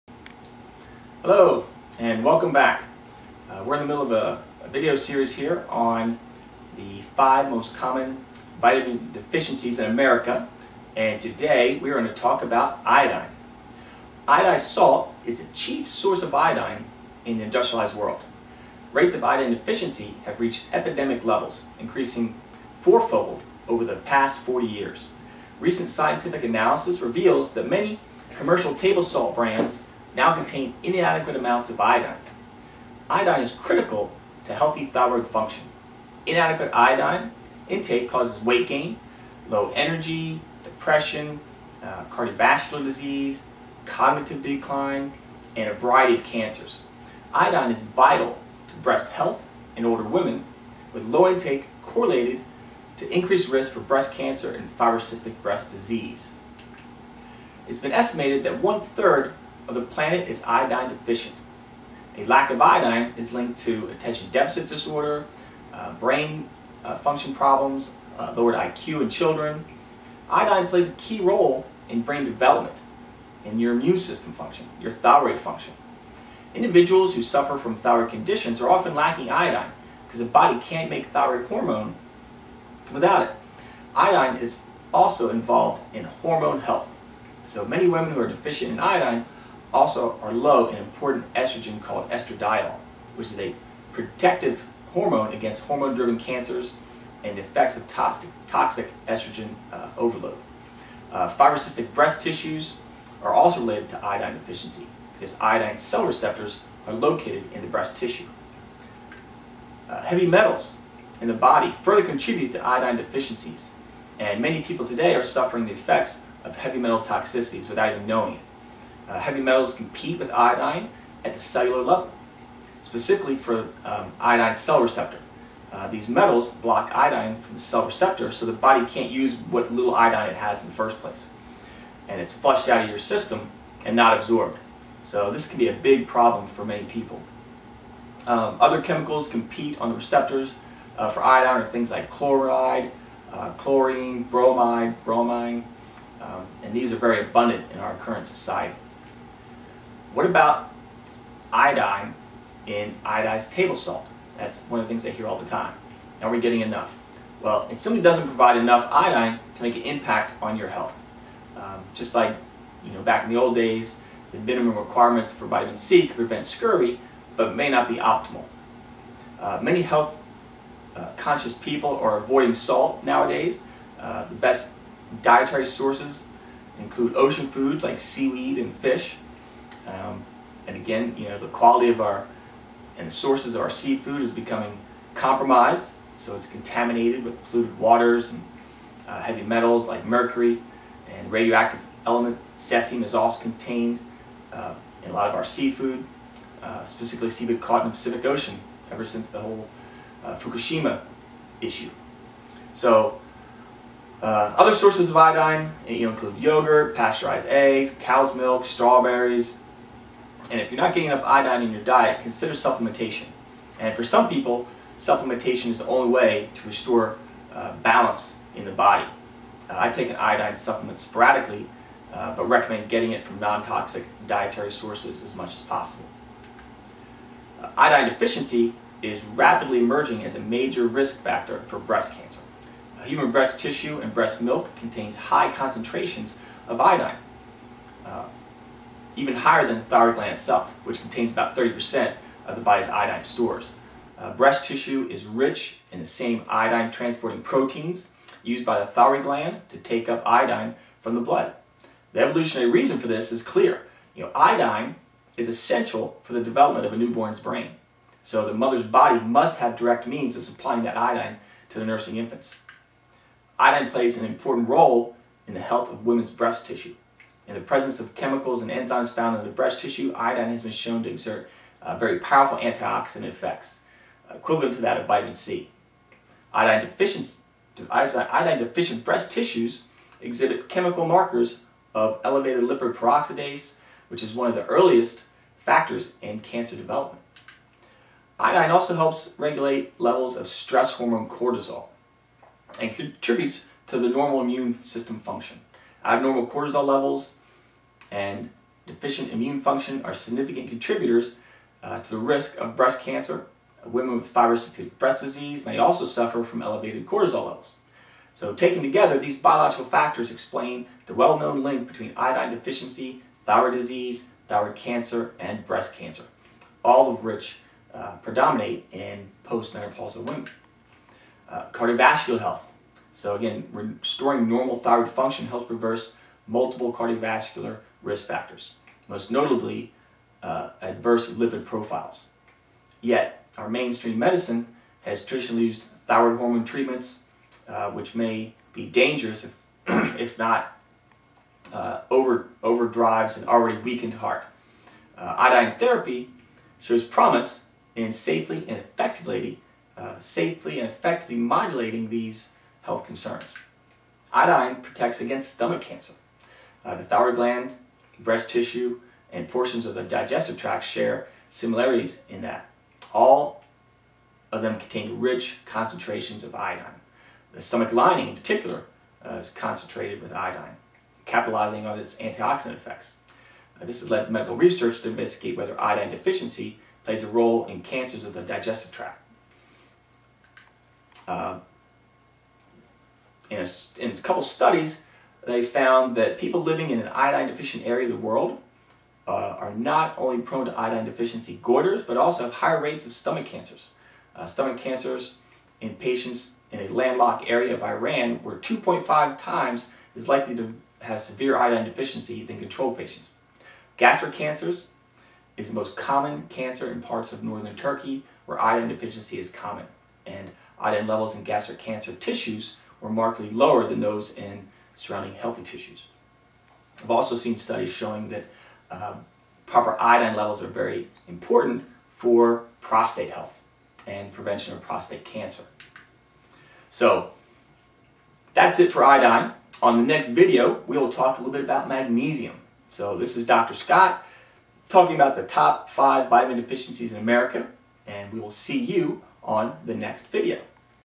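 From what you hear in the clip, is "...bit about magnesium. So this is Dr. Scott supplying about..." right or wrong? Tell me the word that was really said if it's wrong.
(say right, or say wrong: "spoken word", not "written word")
wrong: "talking", not "supplying".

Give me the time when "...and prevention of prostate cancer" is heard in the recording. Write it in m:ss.
7:04.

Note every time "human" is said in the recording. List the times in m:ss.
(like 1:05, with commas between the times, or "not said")
3:53.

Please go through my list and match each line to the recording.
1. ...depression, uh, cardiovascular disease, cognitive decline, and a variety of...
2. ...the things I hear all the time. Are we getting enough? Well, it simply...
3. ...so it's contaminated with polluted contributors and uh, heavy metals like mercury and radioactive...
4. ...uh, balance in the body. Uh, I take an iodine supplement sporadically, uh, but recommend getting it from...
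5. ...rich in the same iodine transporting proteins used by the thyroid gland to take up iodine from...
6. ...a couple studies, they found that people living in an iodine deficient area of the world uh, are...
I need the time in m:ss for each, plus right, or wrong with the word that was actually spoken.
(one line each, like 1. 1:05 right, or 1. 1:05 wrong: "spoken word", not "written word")
1. 0:40 right
2. 2:34 right
3. 3:06 wrong: "waters", not "contributors"
4. 3:37 right
5. 4:05 right
6. 6:24 right.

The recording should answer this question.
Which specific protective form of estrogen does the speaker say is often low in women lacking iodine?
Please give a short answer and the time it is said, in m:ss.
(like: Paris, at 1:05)
estradiol, at 1:32.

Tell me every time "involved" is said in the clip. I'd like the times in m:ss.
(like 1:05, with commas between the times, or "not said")
1:25.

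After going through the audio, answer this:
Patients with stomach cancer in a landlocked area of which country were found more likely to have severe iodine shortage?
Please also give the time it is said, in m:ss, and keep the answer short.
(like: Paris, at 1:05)
Iran, at 6:37.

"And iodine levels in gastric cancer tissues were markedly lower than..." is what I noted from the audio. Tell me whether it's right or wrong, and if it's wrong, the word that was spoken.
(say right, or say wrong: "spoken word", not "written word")
right.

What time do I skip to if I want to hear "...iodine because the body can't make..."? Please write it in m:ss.
1:19.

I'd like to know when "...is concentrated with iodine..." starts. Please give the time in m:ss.
6:09.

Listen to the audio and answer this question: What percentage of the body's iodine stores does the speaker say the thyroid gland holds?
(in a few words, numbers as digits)
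30%.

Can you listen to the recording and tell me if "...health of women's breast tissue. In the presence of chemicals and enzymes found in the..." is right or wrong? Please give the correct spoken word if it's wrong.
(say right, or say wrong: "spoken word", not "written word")
right.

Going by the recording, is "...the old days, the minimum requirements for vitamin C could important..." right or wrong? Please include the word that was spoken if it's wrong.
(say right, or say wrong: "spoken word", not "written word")
wrong: "prevent", not "important".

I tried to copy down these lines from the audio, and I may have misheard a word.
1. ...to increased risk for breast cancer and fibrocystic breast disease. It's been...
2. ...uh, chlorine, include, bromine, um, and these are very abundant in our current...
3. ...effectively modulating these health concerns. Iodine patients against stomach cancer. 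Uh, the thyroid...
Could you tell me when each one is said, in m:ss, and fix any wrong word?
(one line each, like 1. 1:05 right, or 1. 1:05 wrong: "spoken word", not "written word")
1. 0:52 right
2. 2:23 wrong: "bromide", not "include"
3. 5:50 wrong: "protects", not "patients".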